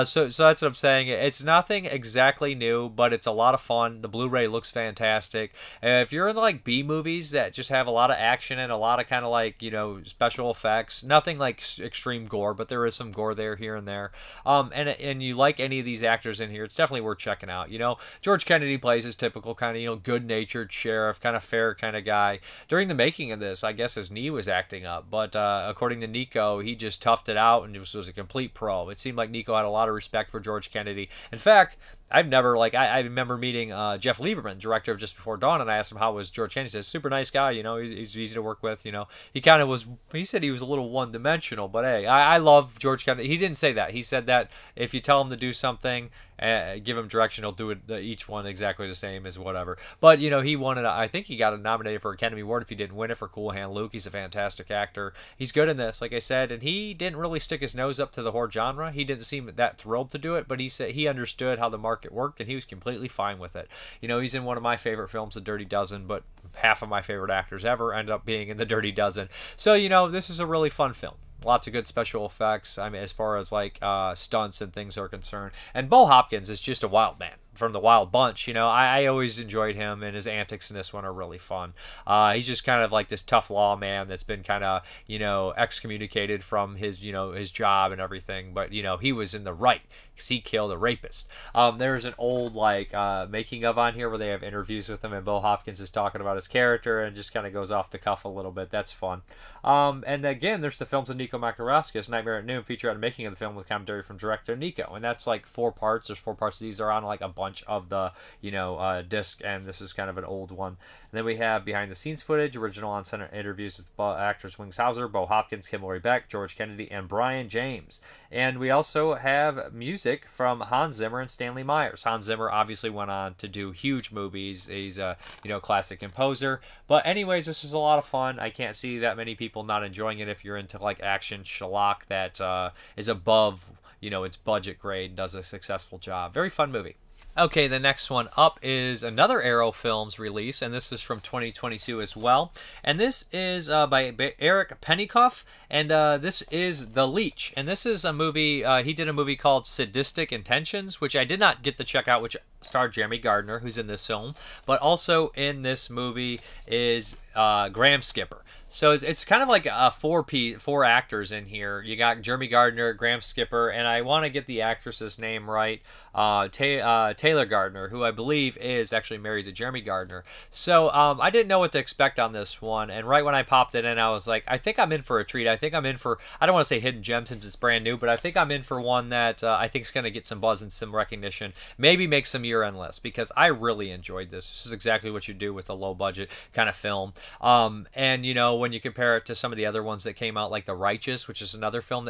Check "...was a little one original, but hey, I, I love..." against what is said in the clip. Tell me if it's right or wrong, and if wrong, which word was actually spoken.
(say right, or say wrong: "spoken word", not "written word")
wrong: "dimensional", not "original".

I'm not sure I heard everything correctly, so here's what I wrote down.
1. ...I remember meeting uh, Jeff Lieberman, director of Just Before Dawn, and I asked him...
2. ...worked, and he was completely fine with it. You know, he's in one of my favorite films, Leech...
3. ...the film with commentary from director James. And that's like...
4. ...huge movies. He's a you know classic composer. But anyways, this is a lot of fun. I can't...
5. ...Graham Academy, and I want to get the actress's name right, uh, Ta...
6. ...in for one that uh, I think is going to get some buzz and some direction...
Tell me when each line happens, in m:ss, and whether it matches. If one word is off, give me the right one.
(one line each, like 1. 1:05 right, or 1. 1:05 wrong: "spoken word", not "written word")
1. 0:32 right
2. 1:02 wrong: "The", not "Leech"
3. 1:43 wrong: "Nico", not "James"
4. 2:03 right
5. 2:42 wrong: "Skipper", not "Academy"
6. 2:58 wrong: "recognition", not "direction".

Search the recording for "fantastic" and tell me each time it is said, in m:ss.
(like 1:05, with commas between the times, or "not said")
0:04, 0:54.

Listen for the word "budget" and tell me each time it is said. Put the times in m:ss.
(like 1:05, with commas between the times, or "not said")
2:14, 3:05.